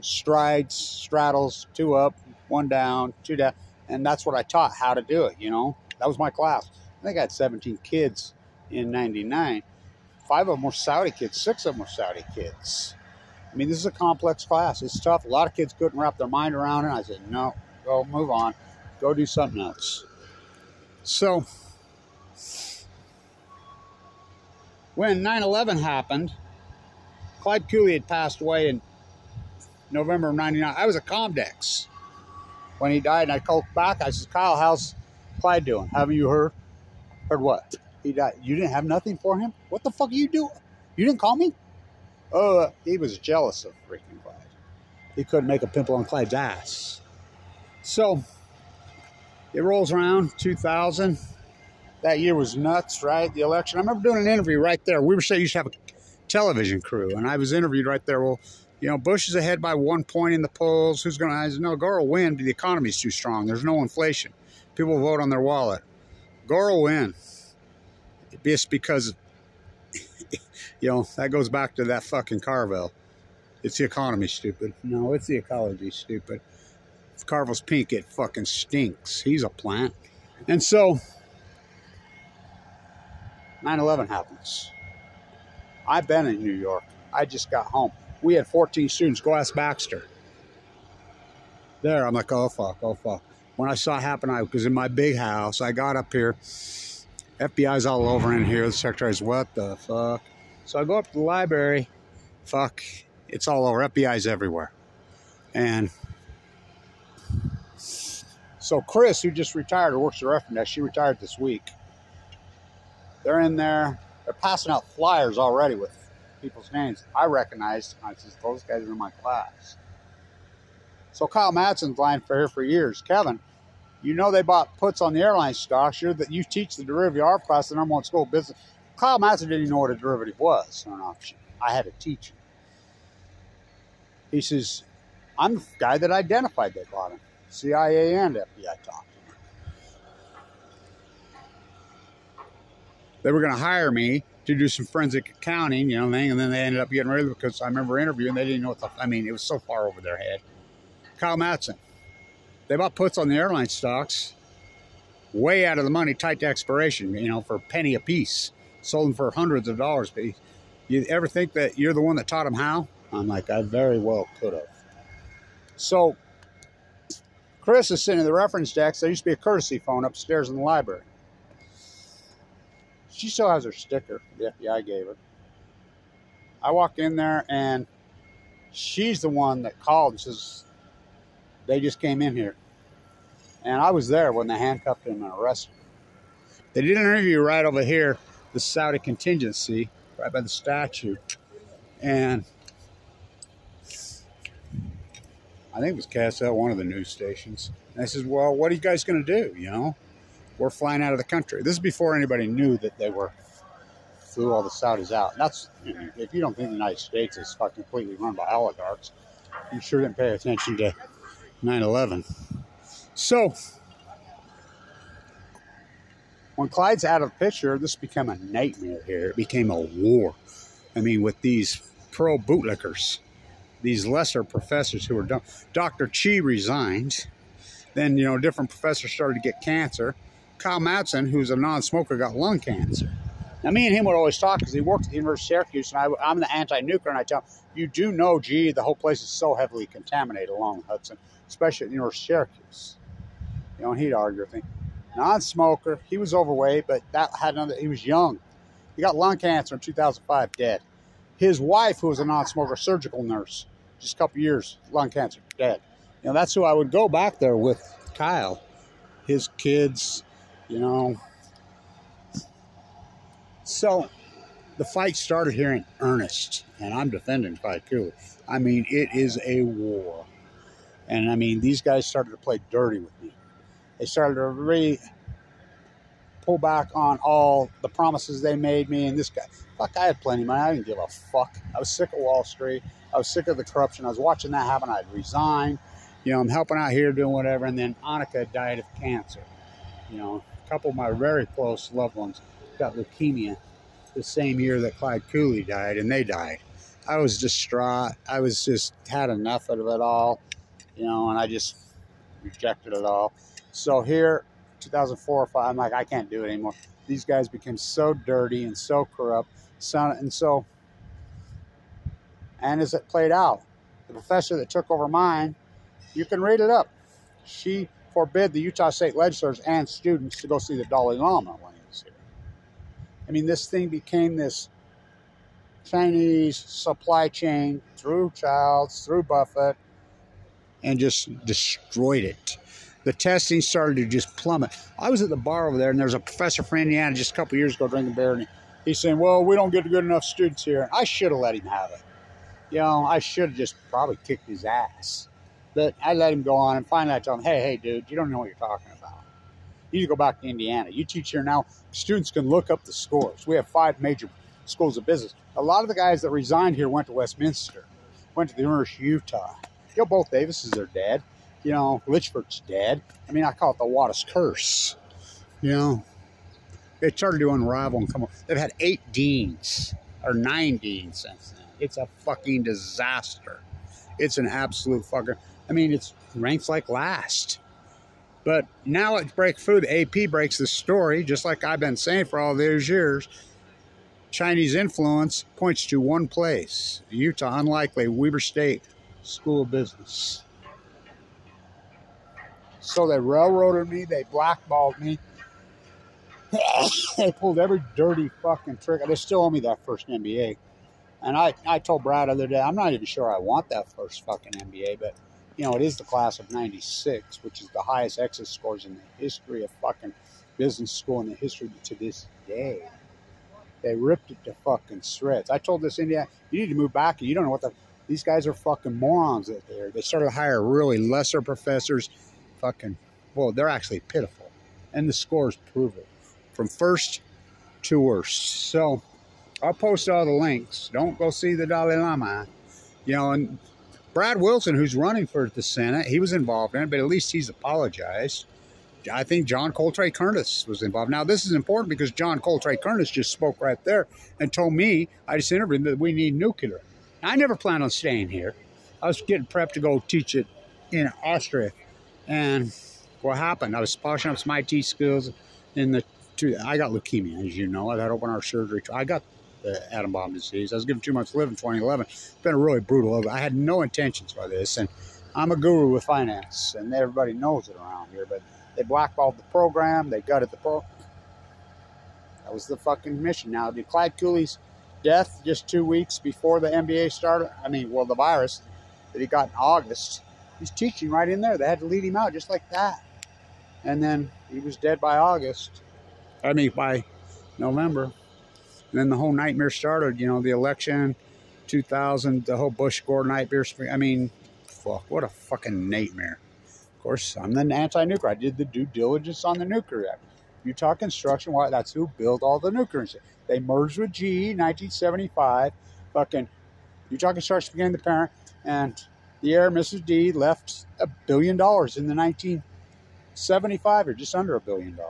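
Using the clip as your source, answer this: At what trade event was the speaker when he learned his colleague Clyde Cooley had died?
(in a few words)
Comdex.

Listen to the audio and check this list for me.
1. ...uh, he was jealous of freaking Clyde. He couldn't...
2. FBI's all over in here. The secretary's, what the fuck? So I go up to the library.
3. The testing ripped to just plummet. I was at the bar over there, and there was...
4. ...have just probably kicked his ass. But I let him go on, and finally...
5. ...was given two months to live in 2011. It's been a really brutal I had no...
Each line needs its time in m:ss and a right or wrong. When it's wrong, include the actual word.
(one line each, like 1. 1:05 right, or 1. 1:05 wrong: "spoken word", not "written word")
1. 0:42 right
2. 1:37 right
3. 5:33 wrong: "started", not "ripped"
4. 5:43 right
5. 7:40 right.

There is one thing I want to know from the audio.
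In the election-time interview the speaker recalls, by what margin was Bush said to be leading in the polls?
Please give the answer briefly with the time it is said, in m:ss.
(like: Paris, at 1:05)
one point, at 0:59.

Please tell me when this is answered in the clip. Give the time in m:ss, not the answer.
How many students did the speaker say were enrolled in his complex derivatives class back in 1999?
0:07.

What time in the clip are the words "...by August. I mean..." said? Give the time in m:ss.
8:05.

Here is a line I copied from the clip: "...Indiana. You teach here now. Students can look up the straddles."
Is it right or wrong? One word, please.
wrong.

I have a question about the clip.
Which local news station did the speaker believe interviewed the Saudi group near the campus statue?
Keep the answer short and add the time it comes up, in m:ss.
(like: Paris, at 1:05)
KSL, at 3:16.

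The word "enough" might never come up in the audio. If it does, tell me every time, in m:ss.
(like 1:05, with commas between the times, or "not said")
4:59, 5:40.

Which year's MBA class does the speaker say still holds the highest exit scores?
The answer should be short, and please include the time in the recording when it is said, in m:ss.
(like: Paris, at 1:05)
96, at 6:46.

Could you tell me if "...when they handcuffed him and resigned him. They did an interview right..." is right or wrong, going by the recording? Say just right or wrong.
wrong.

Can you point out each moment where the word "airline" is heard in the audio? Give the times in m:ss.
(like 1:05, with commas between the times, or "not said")
2:05, 2:33.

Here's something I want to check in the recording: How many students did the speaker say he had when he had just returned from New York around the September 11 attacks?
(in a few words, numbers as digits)
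14.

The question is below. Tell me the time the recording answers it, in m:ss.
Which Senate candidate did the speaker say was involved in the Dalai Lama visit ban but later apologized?
7:14.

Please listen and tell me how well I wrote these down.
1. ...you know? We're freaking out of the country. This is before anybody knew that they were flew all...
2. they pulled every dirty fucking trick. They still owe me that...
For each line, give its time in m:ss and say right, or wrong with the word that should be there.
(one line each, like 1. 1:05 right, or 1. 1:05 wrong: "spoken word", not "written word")
1. 3:19 wrong: "flying", not "freaking"
2. 6:37 right.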